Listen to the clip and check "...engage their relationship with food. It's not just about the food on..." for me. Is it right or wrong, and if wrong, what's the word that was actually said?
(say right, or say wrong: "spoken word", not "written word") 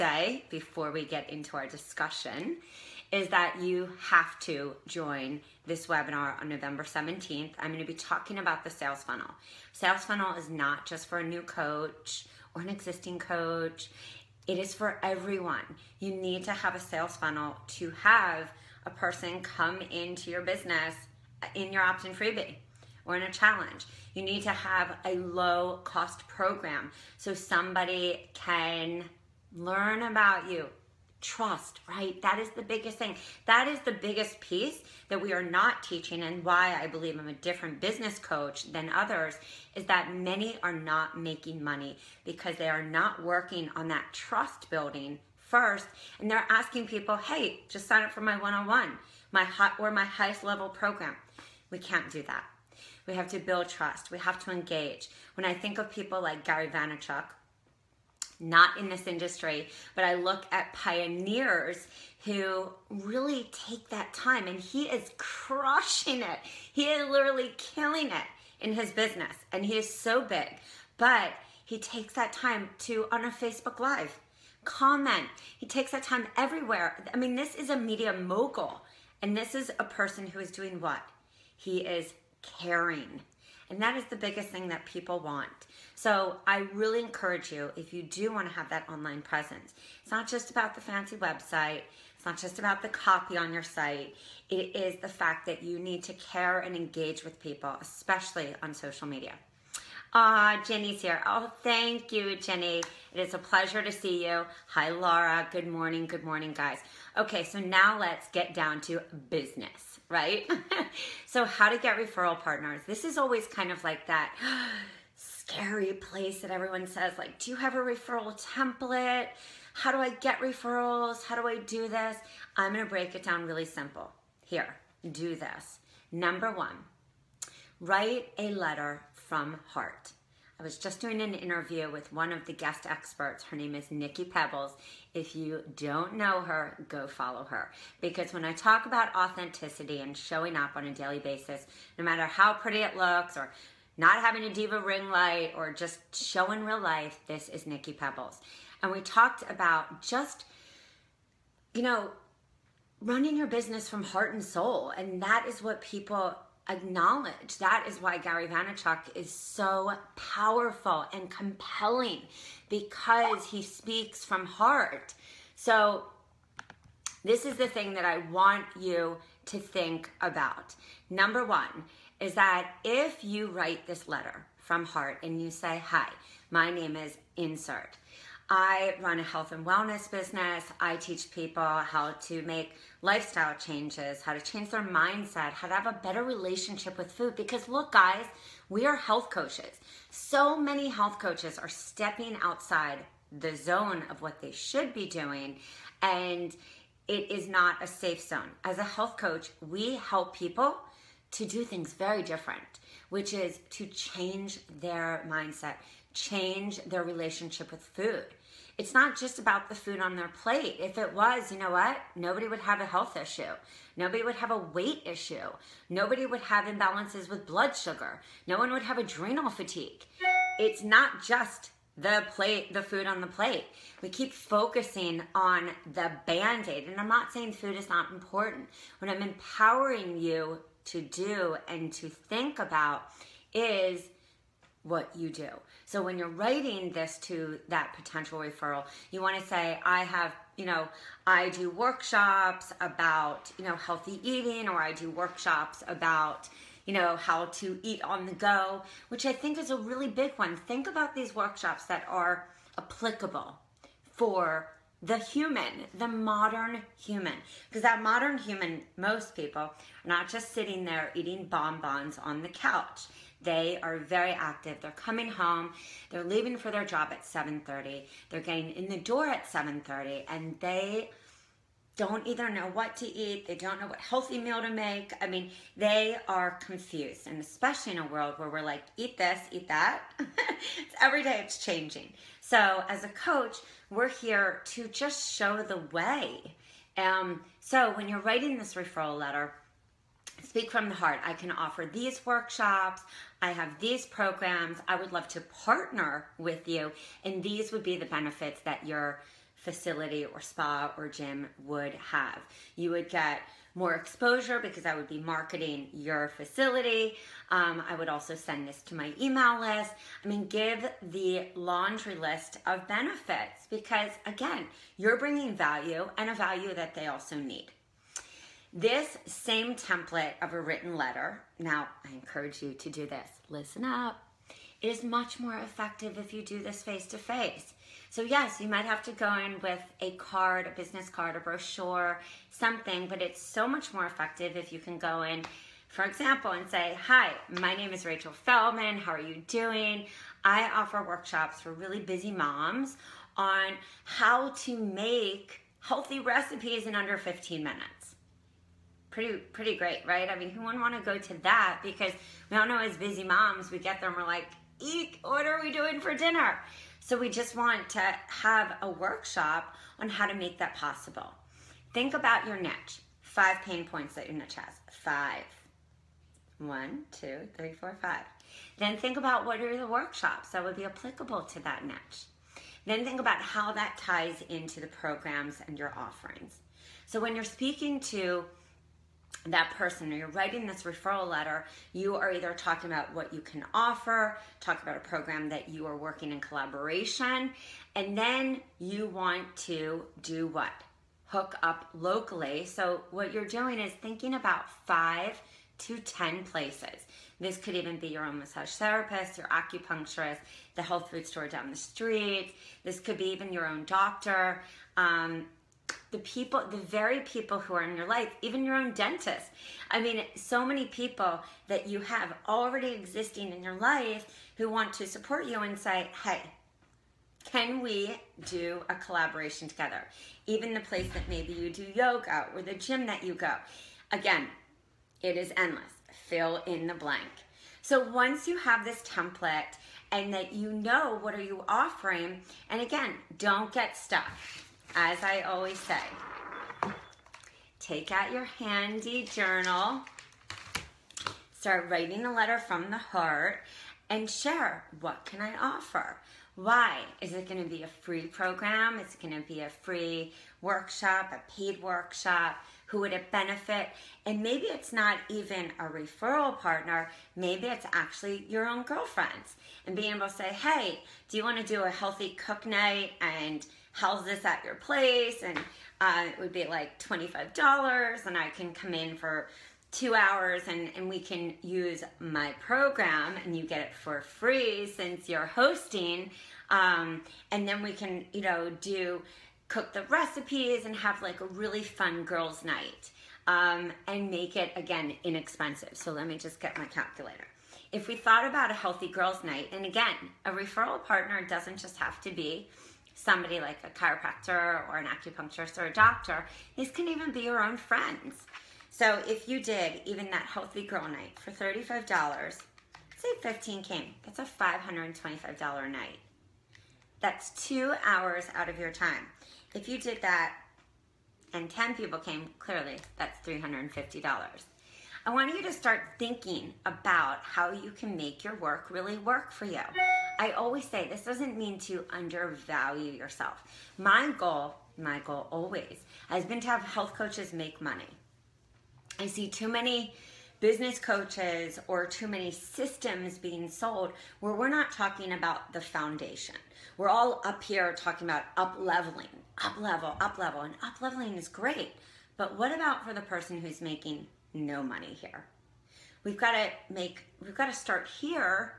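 wrong: "change", not "engage".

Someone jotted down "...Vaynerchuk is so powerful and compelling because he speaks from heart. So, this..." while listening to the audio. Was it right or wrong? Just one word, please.
right.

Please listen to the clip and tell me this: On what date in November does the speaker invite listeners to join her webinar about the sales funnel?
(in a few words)
November 17th.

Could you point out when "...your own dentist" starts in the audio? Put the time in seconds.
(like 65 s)
408 s.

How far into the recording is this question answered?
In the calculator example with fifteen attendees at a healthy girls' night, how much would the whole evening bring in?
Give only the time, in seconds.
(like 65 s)
504 s.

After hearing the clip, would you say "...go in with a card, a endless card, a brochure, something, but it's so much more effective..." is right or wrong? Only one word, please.
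wrong.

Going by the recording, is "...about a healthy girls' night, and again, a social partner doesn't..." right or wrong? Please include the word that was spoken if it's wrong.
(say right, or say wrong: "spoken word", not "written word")
wrong: "referral", not "social".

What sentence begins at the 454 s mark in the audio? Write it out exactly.
And maybe it's not even a referral partner.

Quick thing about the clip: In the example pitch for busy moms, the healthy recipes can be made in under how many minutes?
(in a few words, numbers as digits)
15.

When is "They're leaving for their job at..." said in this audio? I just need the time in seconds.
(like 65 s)
266 s.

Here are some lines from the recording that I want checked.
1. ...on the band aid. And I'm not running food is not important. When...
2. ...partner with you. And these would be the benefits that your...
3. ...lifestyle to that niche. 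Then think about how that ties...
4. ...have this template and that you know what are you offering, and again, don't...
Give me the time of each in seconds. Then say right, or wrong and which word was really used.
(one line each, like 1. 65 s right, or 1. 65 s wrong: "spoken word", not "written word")
1. 225 s wrong: "saying", not "running"
2. 295 s right
3. 370 s wrong: "applicable", not "lifestyle"
4. 428 s right.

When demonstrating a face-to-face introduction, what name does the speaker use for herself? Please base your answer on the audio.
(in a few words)
Rachel Feldman.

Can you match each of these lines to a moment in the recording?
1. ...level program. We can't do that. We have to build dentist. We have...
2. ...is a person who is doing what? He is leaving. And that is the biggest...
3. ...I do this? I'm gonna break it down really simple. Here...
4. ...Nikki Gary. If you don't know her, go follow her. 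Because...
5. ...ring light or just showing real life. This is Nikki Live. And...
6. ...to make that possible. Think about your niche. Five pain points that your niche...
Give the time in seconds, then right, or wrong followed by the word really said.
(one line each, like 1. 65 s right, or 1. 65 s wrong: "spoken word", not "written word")
1. 50 s wrong: "trust", not "dentist"
2. 79 s wrong: "caring", not "leaving"
3. 121 s right
4. 133 s wrong: "Pebbles", not "Gary"
5. 144 s wrong: "Pebbles", not "Live"
6. 360 s right.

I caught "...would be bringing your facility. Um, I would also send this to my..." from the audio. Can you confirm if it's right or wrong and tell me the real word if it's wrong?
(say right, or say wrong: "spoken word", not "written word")
wrong: "marketing", not "bringing".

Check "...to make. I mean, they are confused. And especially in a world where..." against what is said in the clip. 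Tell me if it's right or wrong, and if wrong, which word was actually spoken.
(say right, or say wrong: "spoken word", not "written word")
right.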